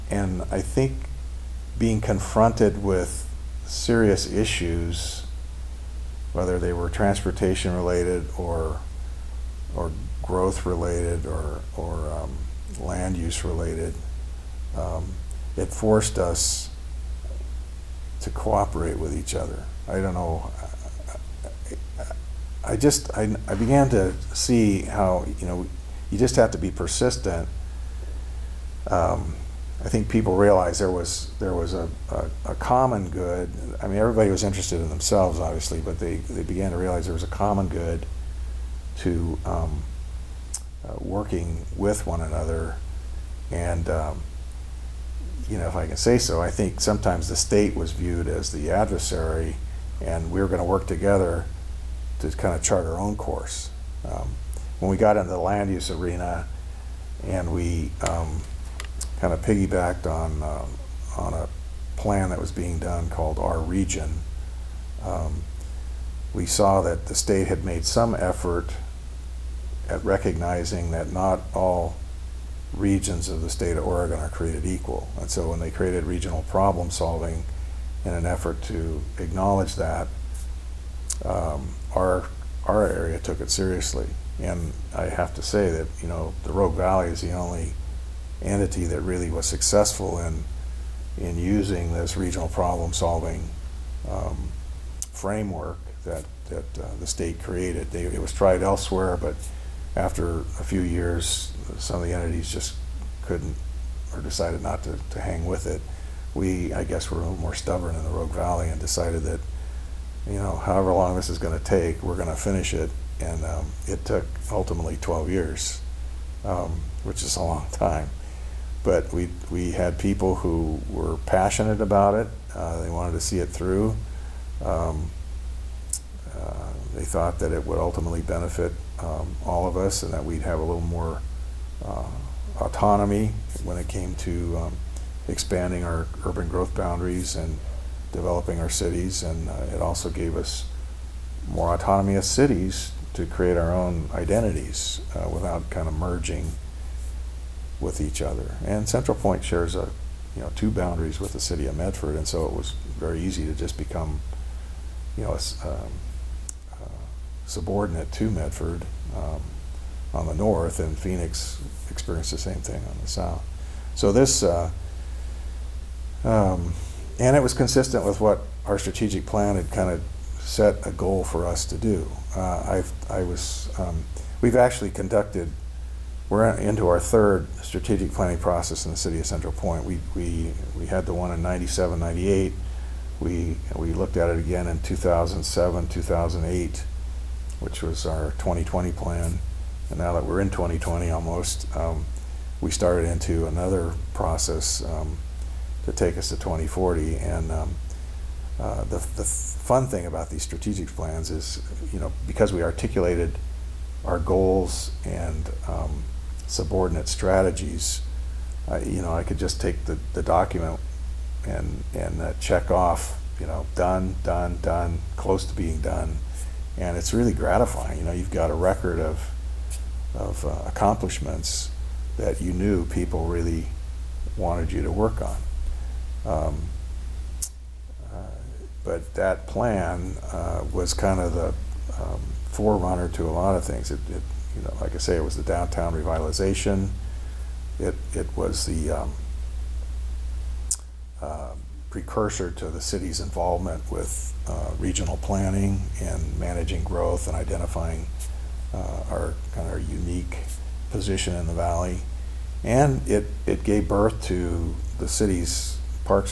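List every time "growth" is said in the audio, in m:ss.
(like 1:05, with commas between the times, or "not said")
0:10, 2:16, 4:06.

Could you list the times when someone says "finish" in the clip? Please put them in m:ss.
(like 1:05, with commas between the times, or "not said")
1:52.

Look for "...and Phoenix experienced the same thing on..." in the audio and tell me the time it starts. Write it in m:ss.
2:40.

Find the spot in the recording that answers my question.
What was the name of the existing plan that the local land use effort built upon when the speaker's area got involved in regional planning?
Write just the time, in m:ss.
1:03.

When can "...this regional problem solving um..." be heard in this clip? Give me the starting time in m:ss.
1:31.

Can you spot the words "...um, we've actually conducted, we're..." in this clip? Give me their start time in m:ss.
2:53.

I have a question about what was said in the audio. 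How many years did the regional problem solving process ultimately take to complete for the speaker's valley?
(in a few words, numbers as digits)
12.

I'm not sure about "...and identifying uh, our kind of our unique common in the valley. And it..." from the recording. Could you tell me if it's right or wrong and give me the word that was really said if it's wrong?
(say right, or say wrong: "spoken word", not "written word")
wrong: "position", not "common".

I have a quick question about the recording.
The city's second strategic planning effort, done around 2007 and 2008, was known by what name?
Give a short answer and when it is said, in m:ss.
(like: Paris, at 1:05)
2020 plan, at 3:08.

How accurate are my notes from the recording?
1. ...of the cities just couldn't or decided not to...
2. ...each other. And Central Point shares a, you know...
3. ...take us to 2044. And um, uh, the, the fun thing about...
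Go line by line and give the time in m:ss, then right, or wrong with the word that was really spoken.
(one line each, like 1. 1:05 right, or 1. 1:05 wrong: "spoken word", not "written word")
1. 1:42 wrong: "entities", not "cities"
2. 2:28 right
3. 3:15 wrong: "2040", not "2044".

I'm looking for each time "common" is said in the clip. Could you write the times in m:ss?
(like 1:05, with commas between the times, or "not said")
0:32, 0:37.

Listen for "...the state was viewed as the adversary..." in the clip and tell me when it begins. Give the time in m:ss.
0:47.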